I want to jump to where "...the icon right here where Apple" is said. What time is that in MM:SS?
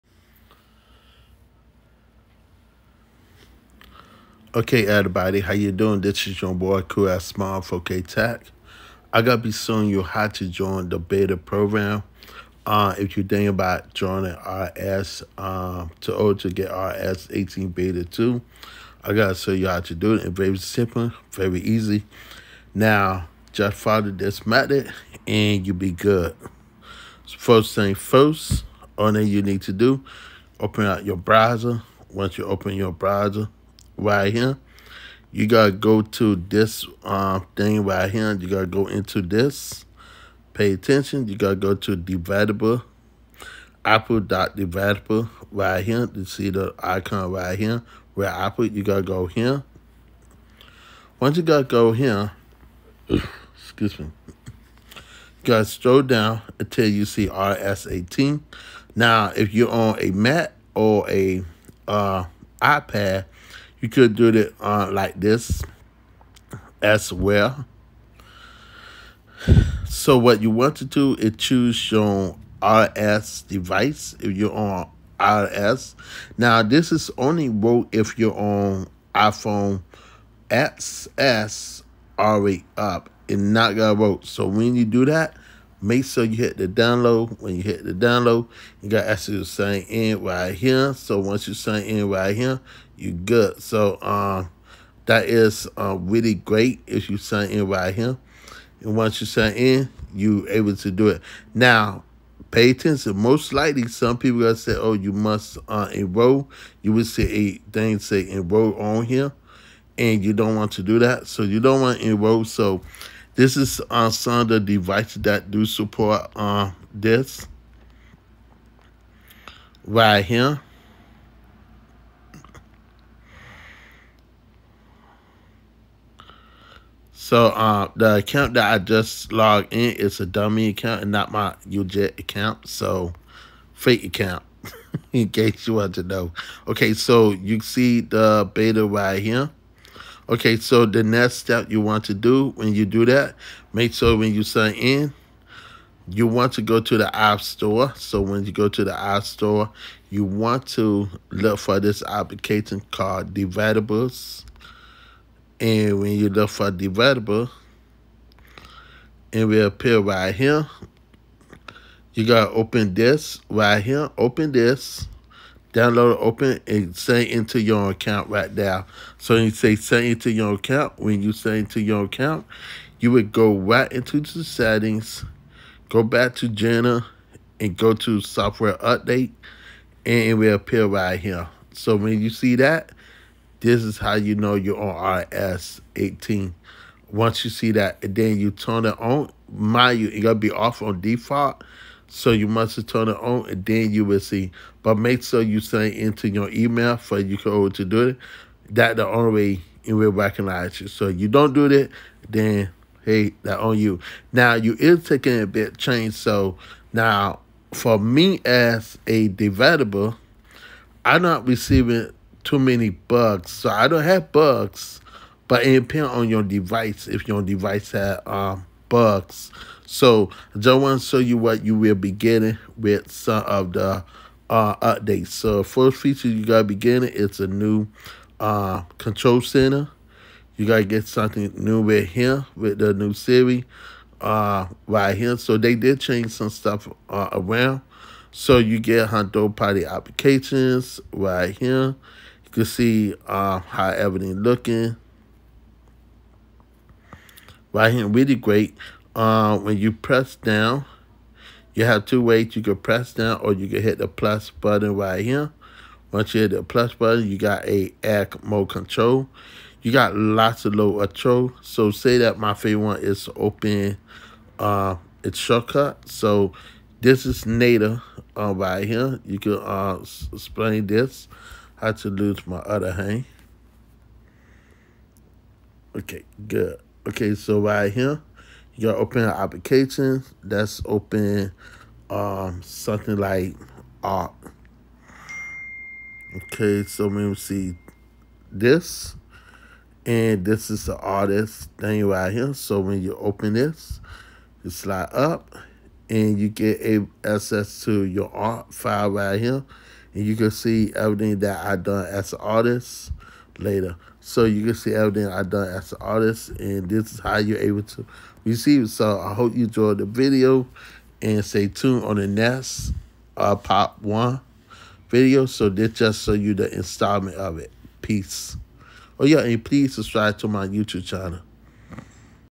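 00:46.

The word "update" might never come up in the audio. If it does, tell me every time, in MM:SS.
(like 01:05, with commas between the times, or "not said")
02:58, 03:44.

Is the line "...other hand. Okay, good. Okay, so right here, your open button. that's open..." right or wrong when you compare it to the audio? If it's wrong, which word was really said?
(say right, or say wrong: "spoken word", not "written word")
wrong: "application", not "button".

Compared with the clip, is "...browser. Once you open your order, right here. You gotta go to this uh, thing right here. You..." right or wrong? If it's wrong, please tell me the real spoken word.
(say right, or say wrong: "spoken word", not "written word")
wrong: "browser", not "order".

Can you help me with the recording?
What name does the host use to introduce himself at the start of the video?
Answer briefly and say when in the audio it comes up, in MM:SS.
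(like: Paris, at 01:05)
Cool Smile, at 00:06.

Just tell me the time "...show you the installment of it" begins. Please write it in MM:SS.
05:16.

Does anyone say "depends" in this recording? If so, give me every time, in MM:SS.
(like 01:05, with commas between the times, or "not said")
03:35.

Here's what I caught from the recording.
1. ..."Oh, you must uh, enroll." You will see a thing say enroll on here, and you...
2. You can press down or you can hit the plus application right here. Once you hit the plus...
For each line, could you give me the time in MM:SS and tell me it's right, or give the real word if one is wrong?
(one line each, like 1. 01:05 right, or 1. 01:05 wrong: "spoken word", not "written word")
1. 01:44 right
2. 04:12 wrong: "button", not "application".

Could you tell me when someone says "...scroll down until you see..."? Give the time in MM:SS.
00:55.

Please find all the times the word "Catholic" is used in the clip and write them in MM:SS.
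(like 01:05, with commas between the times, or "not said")
not said.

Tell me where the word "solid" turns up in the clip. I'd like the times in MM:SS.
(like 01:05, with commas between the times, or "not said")
not said.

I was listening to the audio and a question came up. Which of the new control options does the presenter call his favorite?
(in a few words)
Shortcut.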